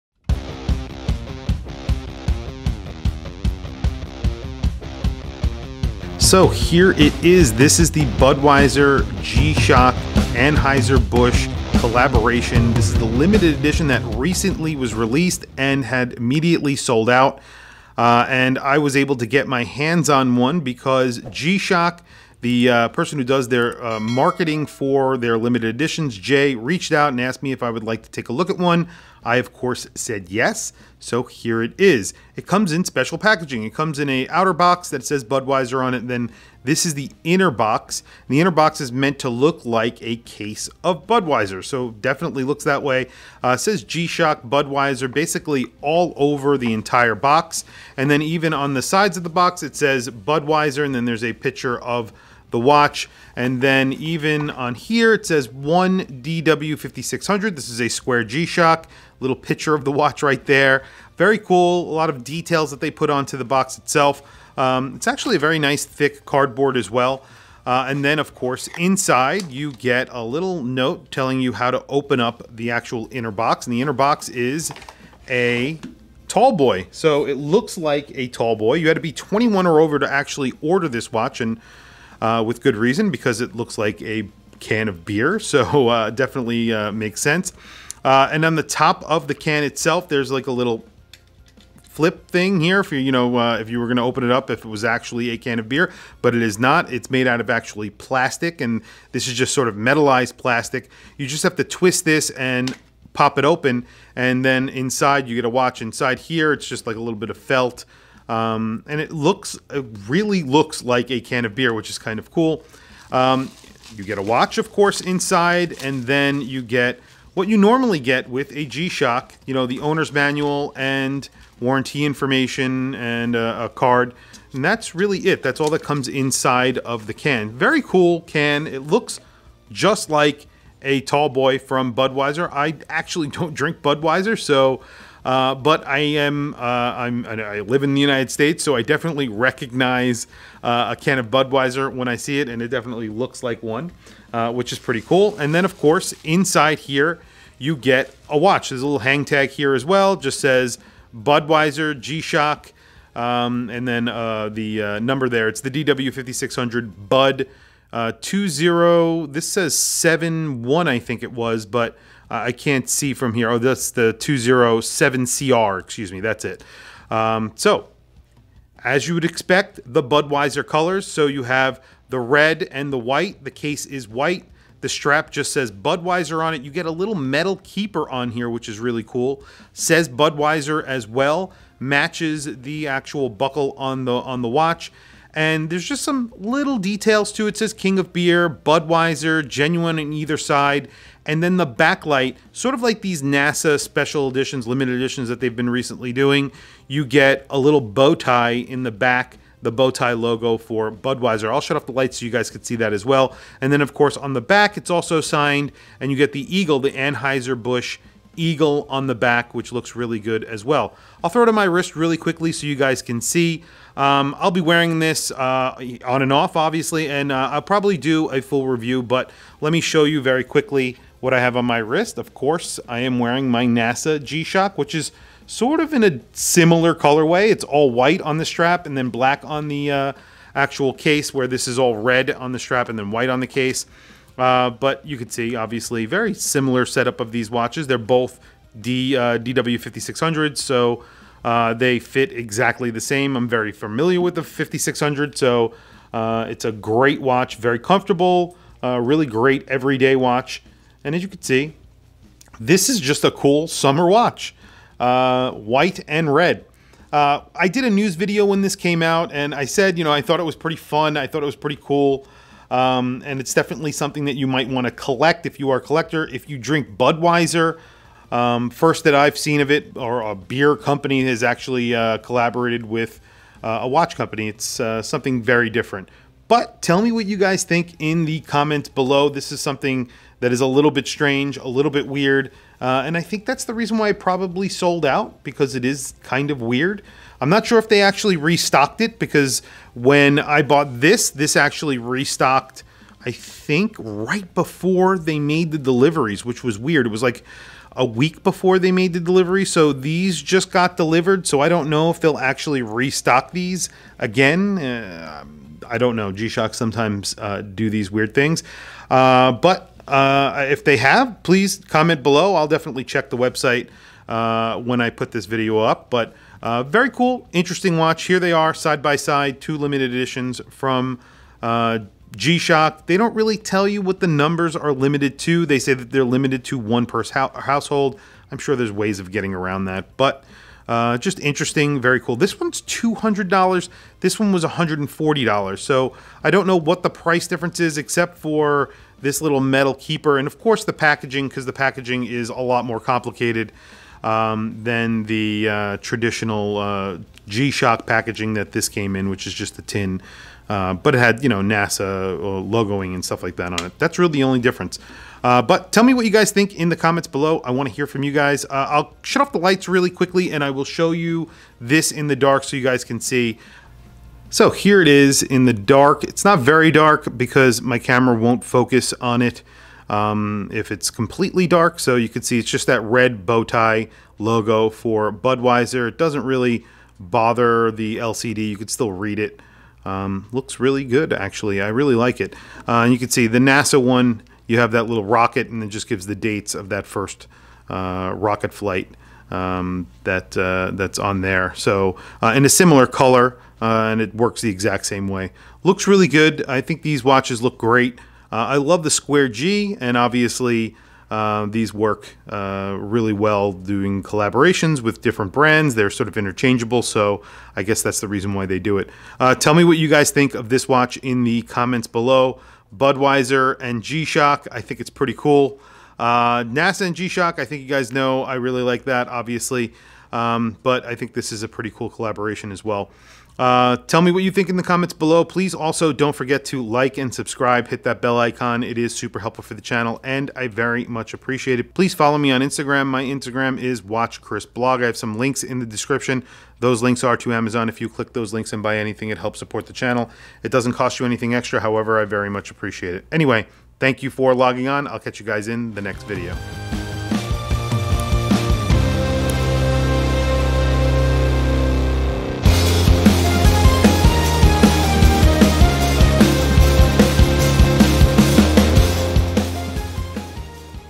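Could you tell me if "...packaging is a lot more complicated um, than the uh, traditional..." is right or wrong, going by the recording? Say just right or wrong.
right.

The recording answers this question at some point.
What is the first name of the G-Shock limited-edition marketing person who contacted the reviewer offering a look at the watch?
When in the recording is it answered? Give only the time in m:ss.
0:26.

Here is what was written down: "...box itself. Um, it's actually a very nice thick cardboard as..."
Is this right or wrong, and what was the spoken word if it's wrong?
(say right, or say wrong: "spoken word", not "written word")
right.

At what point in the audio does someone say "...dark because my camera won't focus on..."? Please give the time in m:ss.
6:06.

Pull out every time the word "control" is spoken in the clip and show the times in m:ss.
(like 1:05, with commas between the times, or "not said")
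not said.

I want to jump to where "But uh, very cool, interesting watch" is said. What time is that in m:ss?
5:16.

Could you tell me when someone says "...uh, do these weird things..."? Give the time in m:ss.
5:07.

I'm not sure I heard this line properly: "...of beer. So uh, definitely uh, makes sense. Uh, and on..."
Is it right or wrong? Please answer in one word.
right.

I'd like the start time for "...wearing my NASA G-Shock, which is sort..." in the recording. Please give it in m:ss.
3:43.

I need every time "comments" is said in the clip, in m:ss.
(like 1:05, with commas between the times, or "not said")
4:38, 5:11, 5:56, 6:51, 7:04.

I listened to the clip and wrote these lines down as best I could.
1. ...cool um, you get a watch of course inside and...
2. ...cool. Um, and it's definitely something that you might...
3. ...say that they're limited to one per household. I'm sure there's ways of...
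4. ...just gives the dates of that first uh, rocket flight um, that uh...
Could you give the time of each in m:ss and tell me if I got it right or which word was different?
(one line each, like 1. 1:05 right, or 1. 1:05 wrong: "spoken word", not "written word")
1. 1:52 right
2. 4:21 right
3. 5:25 right
4. 6:25 right.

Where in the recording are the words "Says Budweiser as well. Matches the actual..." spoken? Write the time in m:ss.
2:59.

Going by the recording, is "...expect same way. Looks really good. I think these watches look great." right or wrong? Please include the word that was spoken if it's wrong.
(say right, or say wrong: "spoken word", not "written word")
wrong: "exact", not "expect".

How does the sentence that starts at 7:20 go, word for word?
It doesn't cost you anything extra.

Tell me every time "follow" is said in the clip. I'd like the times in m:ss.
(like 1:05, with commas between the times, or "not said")
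7:12.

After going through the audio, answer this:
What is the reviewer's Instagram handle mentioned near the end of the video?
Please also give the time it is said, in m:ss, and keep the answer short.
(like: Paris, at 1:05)
watchchrisblog, at 7:14.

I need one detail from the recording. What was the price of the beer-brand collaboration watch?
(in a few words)
$200.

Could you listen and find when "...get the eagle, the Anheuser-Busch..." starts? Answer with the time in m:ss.
3:26.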